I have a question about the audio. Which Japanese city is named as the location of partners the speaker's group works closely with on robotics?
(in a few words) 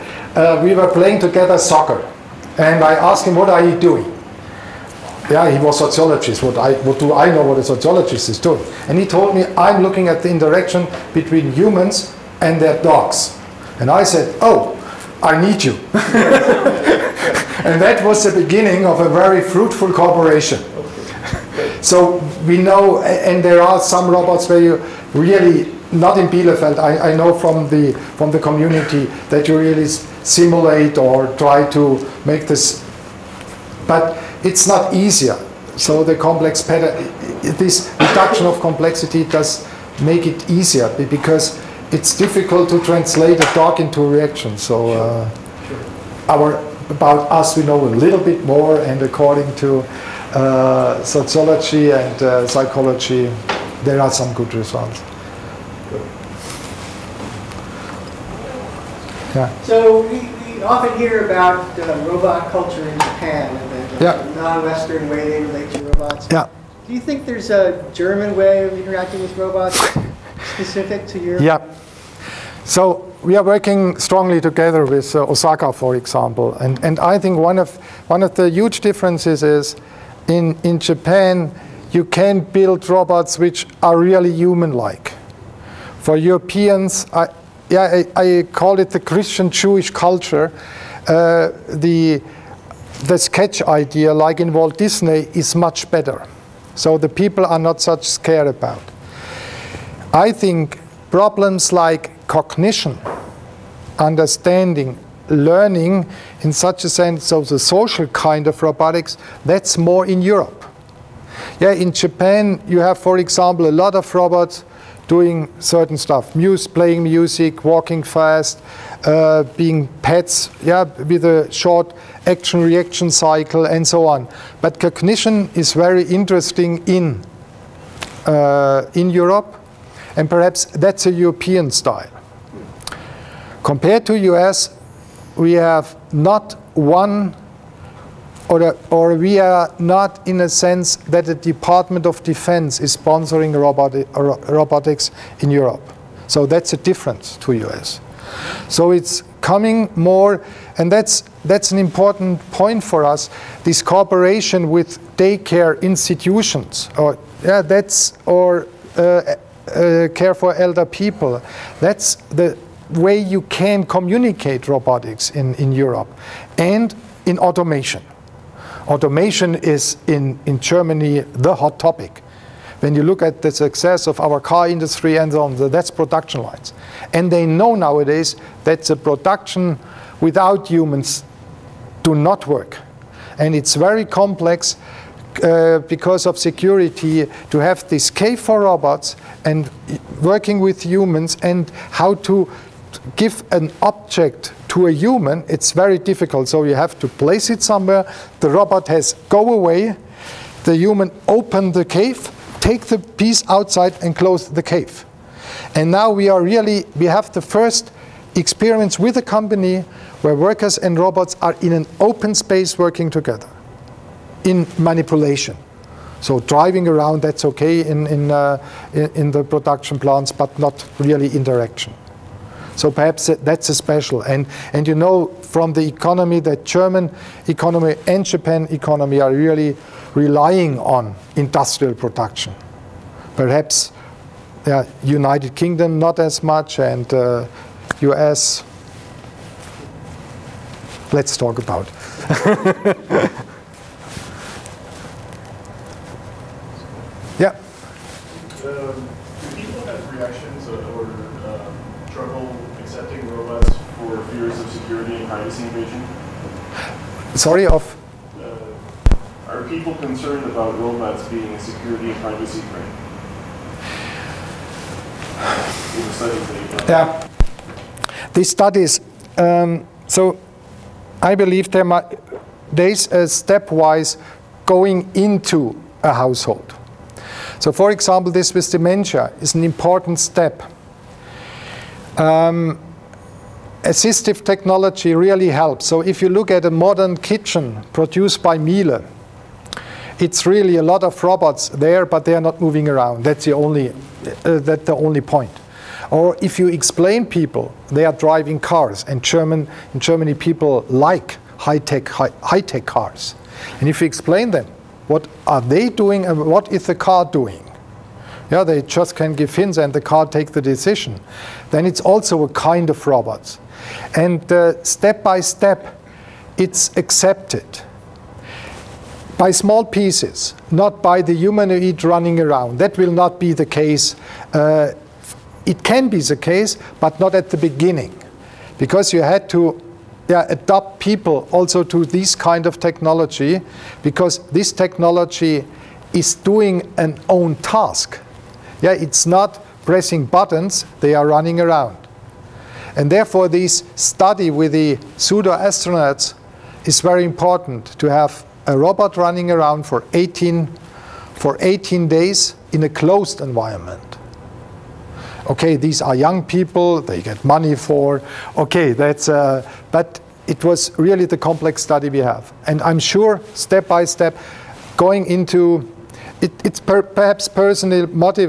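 Osaka.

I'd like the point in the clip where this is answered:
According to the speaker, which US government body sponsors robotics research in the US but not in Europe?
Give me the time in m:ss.
2:21.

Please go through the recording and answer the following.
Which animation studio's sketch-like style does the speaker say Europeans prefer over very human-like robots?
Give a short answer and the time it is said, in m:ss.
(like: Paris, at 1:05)
Walt Disney, at 1:34.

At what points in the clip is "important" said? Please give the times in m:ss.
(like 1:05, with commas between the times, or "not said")
2:31, 4:39, 5:47.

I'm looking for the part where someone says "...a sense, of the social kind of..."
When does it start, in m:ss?
1:46.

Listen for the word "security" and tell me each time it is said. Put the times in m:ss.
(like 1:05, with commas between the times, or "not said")
3:06, 4:21.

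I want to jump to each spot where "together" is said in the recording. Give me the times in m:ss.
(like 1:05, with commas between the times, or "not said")
0:01, 1:14, 3:33.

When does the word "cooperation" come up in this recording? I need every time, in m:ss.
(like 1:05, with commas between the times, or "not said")
0:19, 2:33.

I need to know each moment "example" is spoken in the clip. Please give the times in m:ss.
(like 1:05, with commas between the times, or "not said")
1:15, 1:53, 4:37.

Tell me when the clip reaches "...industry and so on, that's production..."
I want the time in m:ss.
2:54.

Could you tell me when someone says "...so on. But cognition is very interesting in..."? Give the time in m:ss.
2:03.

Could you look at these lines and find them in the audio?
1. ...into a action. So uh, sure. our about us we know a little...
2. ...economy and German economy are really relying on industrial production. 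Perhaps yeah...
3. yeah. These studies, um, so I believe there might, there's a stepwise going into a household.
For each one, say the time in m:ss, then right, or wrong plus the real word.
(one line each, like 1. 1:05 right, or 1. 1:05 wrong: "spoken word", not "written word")
1. 0:43 wrong: "reaction", not "action"
2. 3:47 wrong: "Japan", not "German"
3. 4:26 right.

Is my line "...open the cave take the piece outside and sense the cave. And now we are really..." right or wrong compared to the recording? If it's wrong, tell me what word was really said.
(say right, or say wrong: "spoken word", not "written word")
wrong: "close", not "sense".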